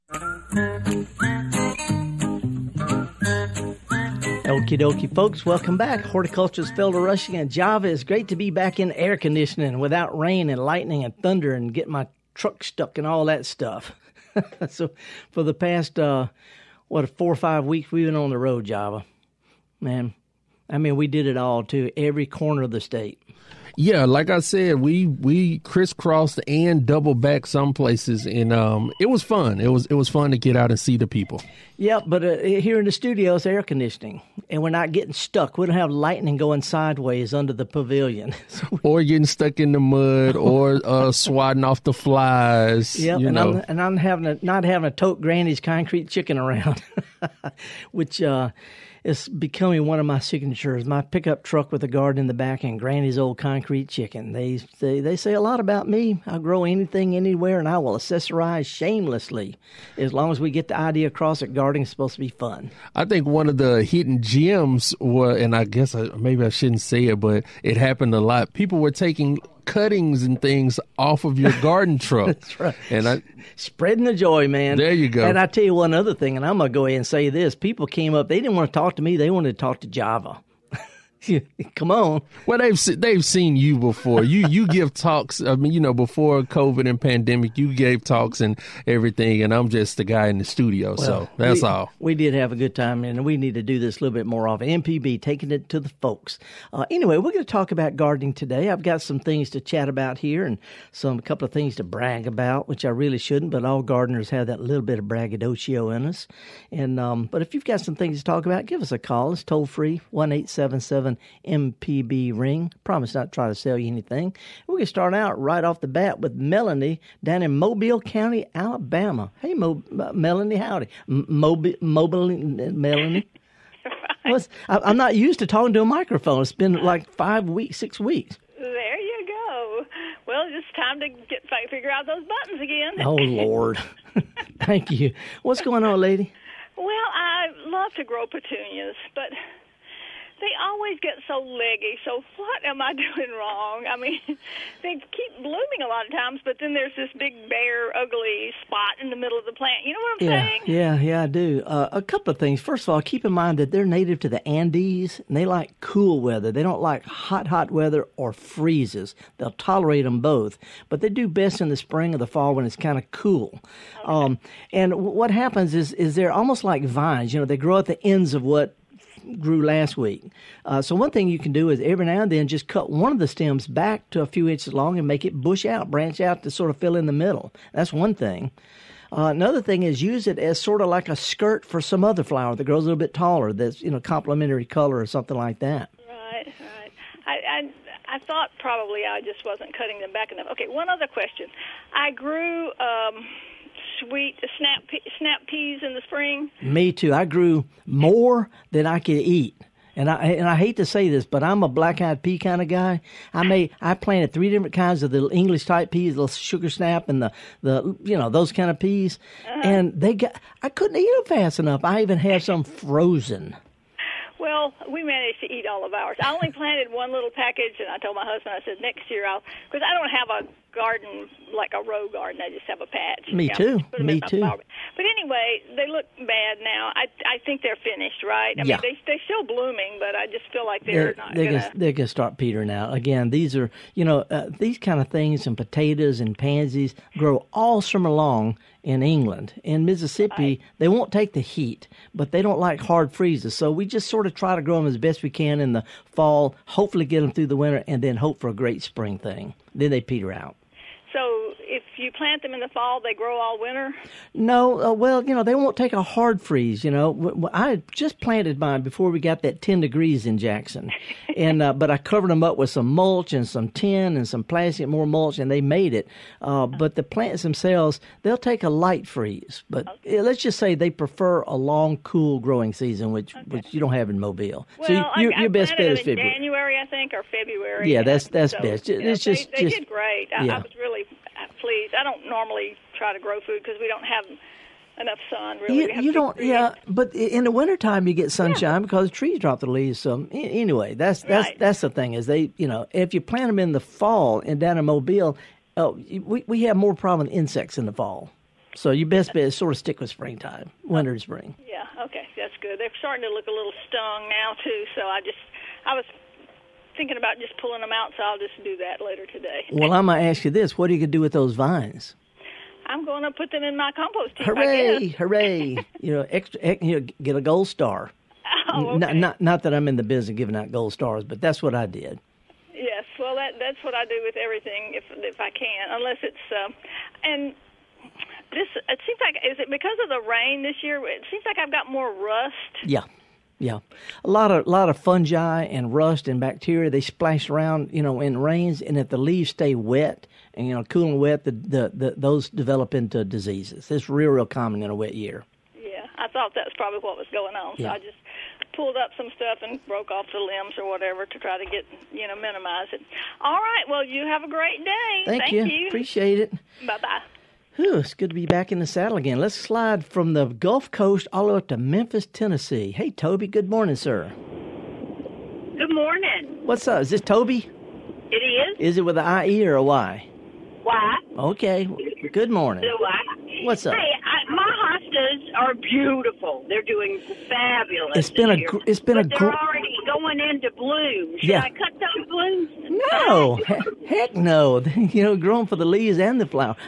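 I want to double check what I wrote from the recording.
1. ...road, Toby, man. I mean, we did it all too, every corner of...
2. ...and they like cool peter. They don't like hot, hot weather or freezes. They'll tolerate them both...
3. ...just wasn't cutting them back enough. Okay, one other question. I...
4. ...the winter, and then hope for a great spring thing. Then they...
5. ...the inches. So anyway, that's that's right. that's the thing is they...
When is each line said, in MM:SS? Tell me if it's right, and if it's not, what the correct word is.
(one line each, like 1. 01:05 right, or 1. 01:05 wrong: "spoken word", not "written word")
1. 00:18 wrong: "Java", not "Toby"
2. 02:35 wrong: "weather", not "peter"
3. 03:09 right
4. 04:07 right
5. 04:49 wrong: "leaves", not "inches".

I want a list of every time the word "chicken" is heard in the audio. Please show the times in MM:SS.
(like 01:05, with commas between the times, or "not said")
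00:46, 00:53.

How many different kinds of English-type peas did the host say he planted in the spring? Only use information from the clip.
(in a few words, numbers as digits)
3.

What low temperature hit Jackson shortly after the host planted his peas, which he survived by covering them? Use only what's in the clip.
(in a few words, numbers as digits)
10 degrees.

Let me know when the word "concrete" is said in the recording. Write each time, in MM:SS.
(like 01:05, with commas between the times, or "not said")
00:45, 00:53.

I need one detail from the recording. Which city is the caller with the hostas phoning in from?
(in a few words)
Memphis, Tennessee.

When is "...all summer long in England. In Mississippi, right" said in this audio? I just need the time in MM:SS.
03:57.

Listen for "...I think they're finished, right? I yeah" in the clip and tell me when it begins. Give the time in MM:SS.
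03:47.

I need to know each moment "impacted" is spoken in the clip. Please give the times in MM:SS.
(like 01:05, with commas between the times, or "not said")
not said.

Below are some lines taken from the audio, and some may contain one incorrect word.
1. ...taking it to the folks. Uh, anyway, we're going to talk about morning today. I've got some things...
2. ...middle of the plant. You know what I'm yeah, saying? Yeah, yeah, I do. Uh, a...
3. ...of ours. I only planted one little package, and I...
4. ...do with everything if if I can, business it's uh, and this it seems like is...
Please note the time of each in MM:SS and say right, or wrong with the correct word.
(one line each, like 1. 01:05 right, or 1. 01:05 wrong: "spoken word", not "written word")
1. 01:35 wrong: "gardening", not "morning"
2. 02:29 right
3. 03:35 right
4. 05:24 wrong: "unless", not "business".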